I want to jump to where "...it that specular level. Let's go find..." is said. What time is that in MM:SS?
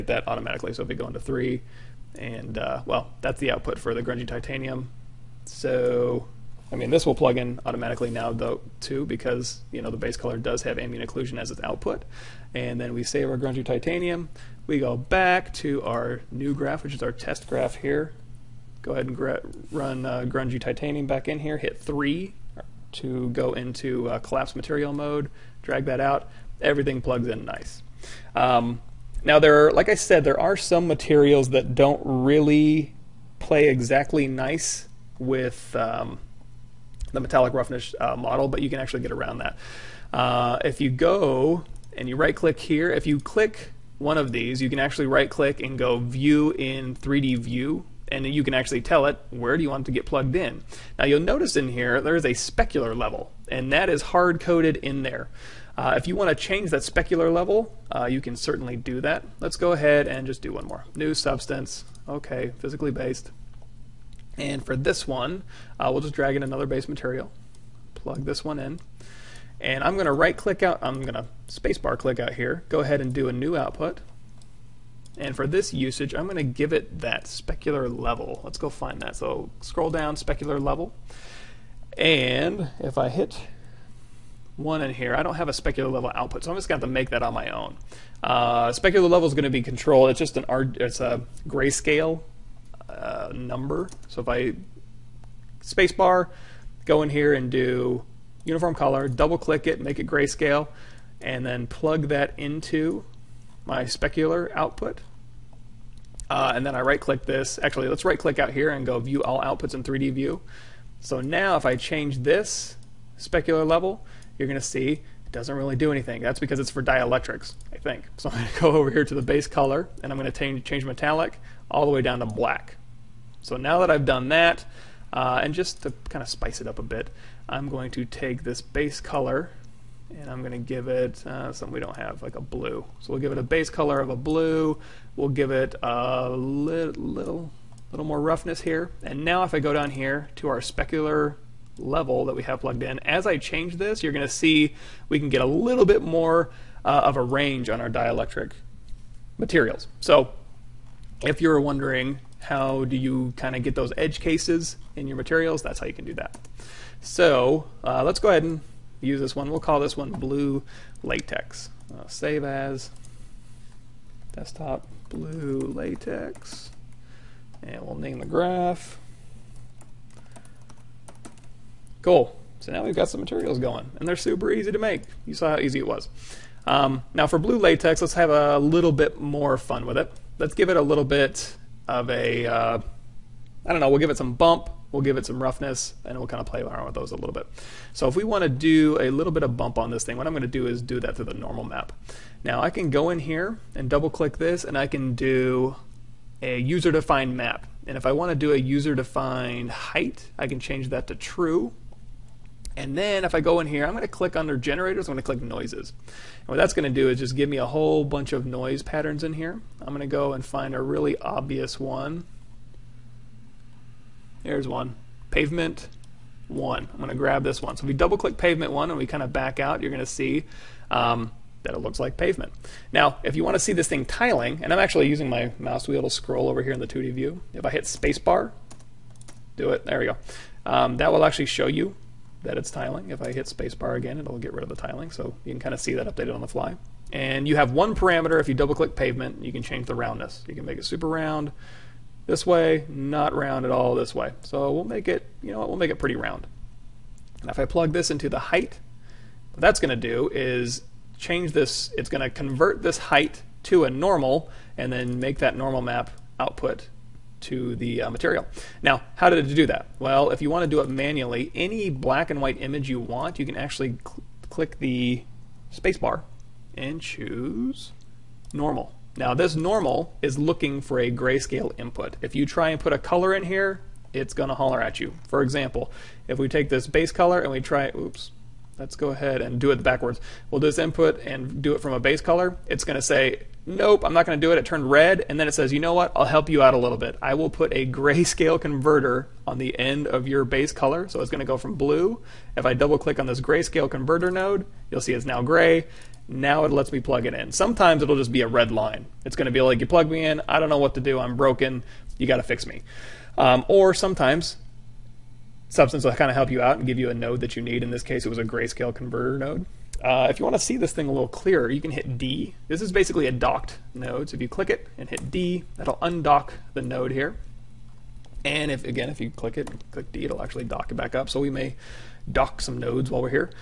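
01:16.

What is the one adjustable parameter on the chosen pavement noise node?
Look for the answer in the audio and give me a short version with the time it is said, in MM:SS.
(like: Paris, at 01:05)
roundness, at 03:59.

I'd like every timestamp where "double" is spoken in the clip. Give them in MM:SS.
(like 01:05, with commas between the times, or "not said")
01:39, 03:13, 03:37, 03:58, 04:52.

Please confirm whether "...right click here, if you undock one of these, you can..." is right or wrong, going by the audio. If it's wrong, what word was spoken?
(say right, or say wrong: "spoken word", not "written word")
wrong: "click", not "undock".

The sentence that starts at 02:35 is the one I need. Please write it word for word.
That's how you can do that.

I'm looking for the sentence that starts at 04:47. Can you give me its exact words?
I will put a grayscale converter on the end of your base color.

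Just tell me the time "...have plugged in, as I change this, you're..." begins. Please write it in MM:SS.
02:22.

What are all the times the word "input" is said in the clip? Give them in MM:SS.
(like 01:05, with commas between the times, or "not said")
04:31, 04:40.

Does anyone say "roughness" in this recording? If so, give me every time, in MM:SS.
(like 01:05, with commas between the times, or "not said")
00:37, 02:18, 03:05.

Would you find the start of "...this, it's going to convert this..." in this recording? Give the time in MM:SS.
04:11.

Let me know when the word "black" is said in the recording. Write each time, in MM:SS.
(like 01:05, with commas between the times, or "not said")
02:02, 04:21.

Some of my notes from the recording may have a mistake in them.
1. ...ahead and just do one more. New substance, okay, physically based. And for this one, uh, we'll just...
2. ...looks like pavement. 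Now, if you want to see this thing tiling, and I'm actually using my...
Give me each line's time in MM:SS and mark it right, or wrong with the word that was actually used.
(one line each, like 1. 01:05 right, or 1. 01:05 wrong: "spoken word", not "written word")
1. 00:59 right
2. 03:41 right.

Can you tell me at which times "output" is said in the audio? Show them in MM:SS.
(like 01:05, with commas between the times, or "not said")
00:03, 00:11, 01:13, 01:26, 01:44, 01:49, 04:16.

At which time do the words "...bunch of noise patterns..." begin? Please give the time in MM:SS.
03:28.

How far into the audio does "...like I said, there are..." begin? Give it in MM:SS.
00:29.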